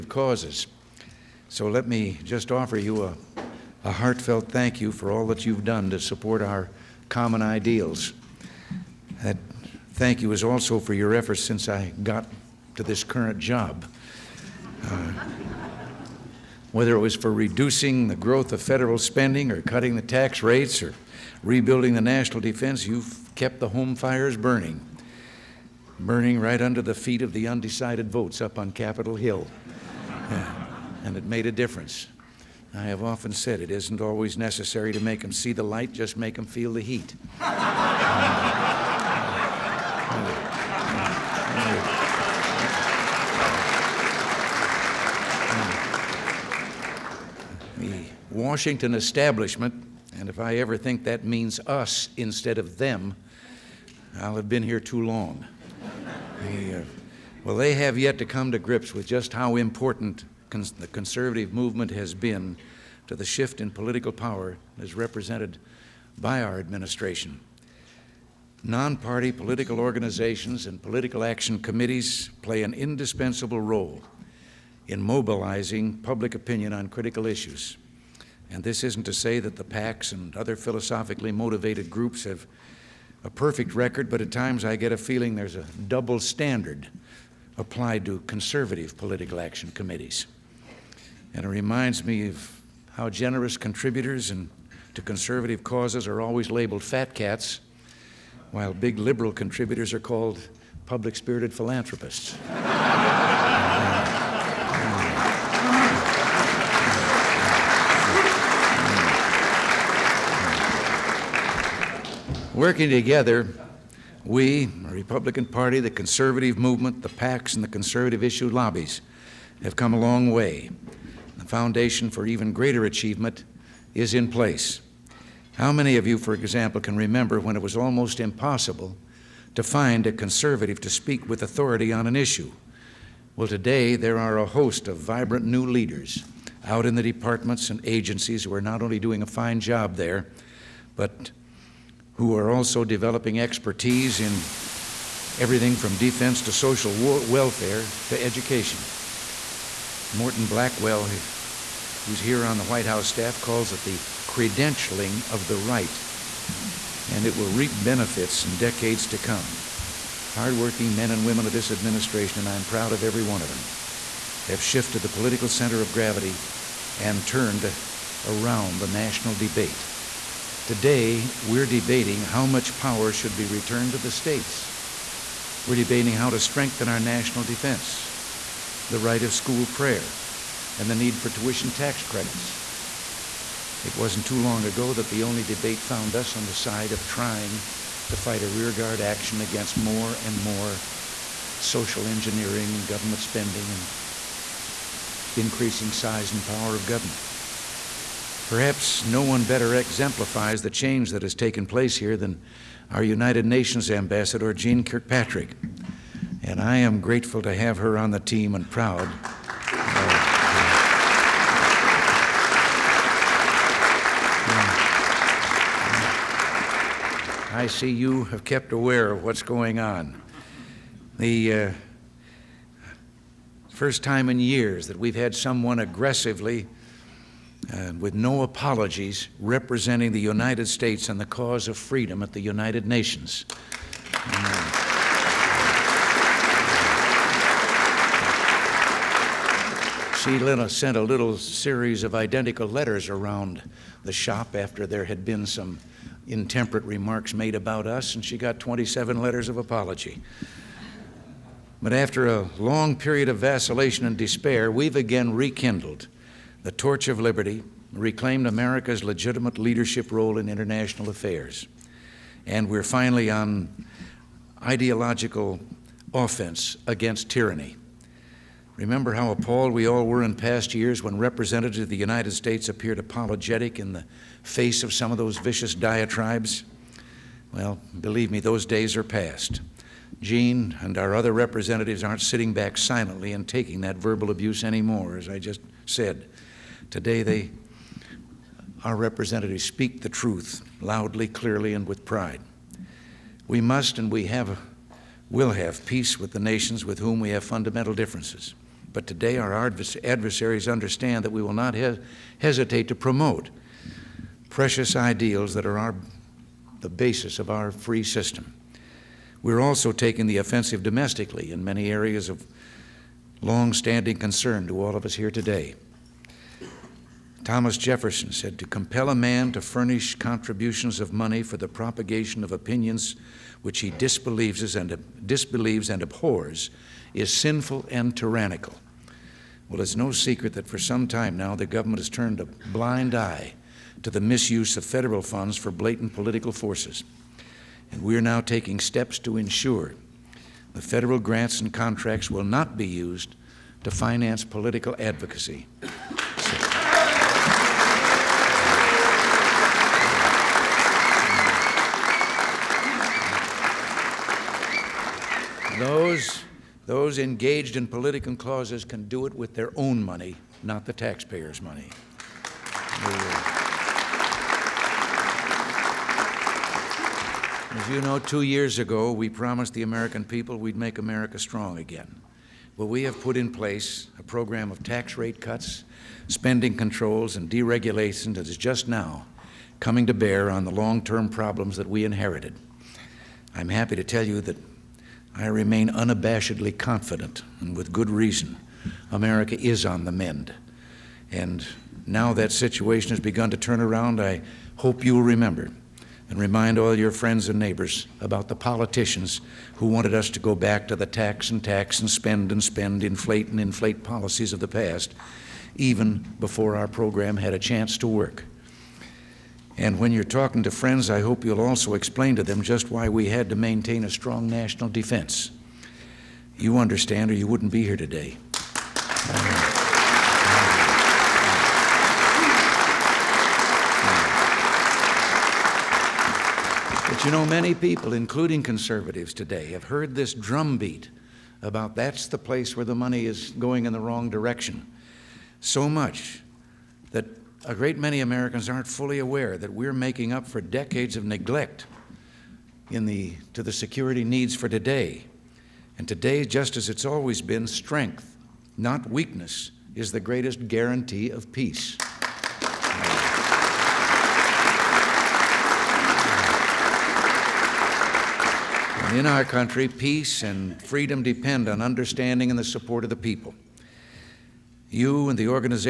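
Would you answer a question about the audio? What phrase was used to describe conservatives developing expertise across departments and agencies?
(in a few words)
the credentialing of the right.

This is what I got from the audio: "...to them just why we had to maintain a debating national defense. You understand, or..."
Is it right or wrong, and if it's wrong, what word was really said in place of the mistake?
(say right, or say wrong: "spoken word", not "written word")
wrong: "strong", not "debating".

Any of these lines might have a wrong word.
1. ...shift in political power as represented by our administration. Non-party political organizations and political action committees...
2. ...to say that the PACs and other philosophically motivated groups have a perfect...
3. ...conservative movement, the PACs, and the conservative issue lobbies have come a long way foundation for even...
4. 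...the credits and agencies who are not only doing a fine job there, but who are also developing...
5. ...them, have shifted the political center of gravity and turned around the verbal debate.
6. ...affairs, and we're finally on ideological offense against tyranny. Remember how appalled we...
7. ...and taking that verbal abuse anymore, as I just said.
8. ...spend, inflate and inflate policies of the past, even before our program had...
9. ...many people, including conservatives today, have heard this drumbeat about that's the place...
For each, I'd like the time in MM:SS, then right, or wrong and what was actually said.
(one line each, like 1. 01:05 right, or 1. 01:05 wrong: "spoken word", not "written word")
1. 01:03 right
2. 01:19 right
3. 01:55 right
4. 02:16 wrong: "departments", not "credits"
5. 02:43 wrong: "national", not "verbal"
6. 04:21 right
7. 04:43 right
8. 06:42 right
9. 07:07 right.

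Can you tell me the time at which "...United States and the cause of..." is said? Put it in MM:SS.
03:50.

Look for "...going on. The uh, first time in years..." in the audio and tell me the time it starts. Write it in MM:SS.
03:39.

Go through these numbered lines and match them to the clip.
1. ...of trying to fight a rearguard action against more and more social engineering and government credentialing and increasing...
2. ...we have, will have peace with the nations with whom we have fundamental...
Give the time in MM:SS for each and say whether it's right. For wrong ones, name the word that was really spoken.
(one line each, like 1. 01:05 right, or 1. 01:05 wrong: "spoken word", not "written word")
1. 03:06 wrong: "spending", not "credentialing"
2. 04:54 right.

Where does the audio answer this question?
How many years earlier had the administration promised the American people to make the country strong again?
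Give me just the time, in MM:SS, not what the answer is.
06:08.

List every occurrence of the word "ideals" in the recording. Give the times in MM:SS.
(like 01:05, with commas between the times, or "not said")
00:07, 05:04.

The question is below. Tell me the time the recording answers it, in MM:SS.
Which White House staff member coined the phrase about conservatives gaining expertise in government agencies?
02:30.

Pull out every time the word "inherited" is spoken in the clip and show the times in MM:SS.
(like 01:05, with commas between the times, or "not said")
06:22.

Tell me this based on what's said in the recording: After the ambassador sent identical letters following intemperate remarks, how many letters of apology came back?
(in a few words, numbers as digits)
27.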